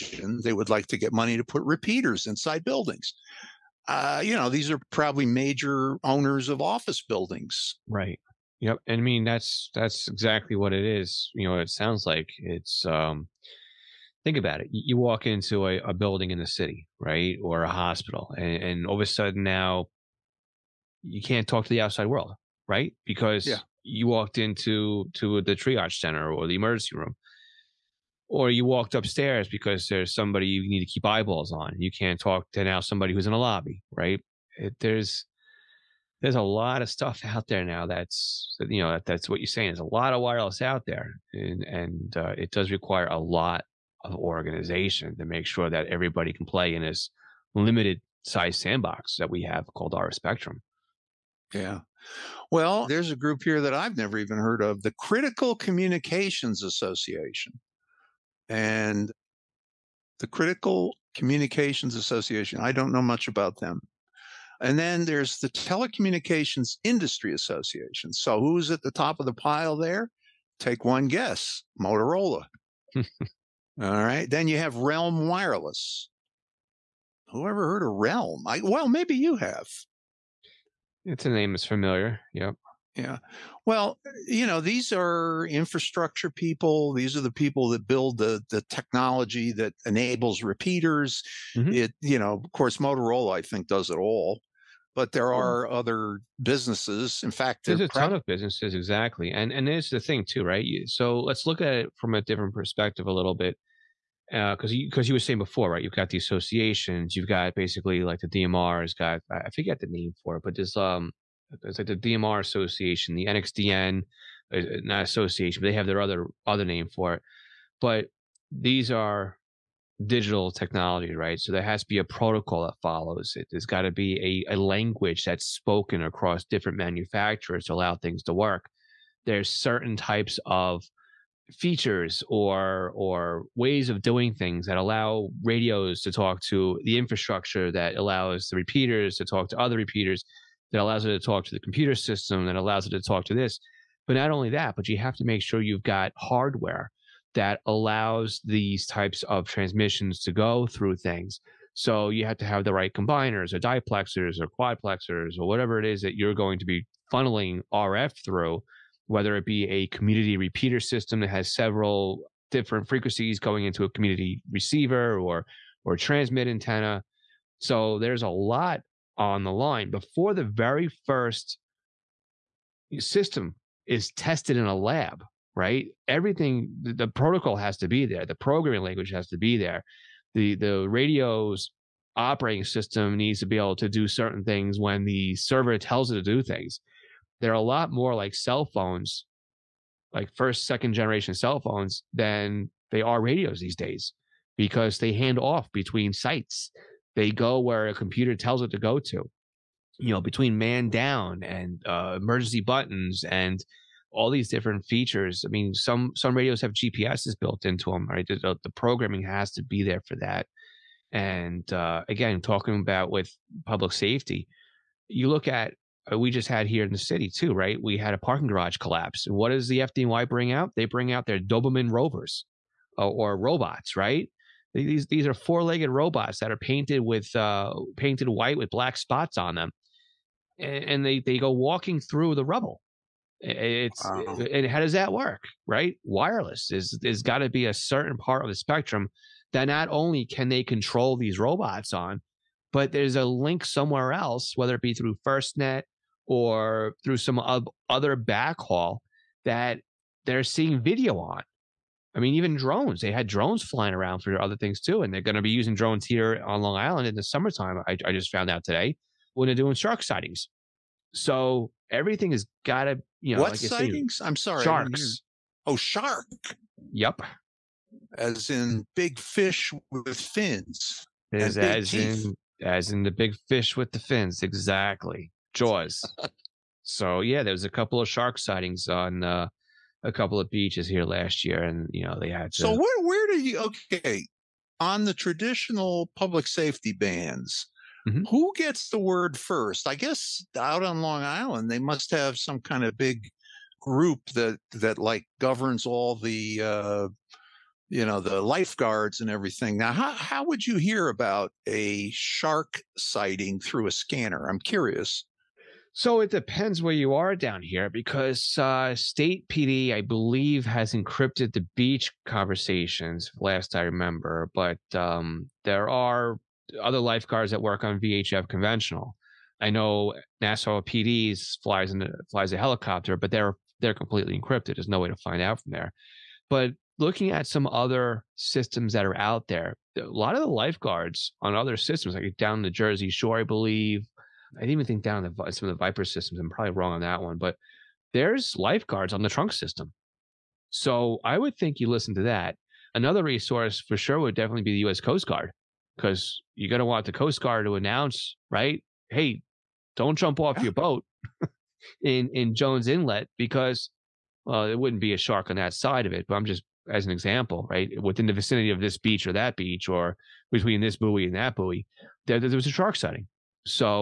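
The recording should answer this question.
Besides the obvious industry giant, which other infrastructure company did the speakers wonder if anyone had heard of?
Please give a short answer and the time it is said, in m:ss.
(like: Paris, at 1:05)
RELM Wireless, at 1:14.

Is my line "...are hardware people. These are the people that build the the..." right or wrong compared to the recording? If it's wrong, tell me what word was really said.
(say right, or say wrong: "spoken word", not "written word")
wrong: "infrastructure", not "hardware".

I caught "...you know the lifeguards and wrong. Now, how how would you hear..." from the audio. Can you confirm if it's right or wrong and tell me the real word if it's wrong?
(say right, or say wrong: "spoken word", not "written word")
wrong: "everything", not "wrong".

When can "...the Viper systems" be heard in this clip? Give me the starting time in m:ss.
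5:35.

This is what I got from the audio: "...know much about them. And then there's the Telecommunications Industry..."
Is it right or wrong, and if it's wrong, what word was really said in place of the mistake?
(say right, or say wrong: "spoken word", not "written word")
right.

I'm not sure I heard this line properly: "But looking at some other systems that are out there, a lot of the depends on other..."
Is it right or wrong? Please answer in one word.
wrong.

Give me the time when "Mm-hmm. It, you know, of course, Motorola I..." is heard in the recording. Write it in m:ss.
1:31.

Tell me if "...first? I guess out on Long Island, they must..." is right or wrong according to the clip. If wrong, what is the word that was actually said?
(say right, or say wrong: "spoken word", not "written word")
right.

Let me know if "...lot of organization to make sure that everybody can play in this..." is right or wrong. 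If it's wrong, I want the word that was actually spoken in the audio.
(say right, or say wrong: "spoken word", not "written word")
right.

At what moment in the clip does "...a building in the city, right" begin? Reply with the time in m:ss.
0:15.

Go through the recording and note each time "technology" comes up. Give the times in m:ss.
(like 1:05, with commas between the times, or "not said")
1:28, 2:00.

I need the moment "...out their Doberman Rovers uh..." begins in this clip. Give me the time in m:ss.
3:41.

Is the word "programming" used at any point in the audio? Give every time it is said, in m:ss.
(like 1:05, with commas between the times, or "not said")
2:58, 3:28.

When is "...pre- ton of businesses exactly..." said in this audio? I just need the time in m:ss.
1:37.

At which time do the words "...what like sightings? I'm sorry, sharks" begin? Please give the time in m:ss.
4:23.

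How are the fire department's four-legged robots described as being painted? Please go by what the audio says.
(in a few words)
white with black spots.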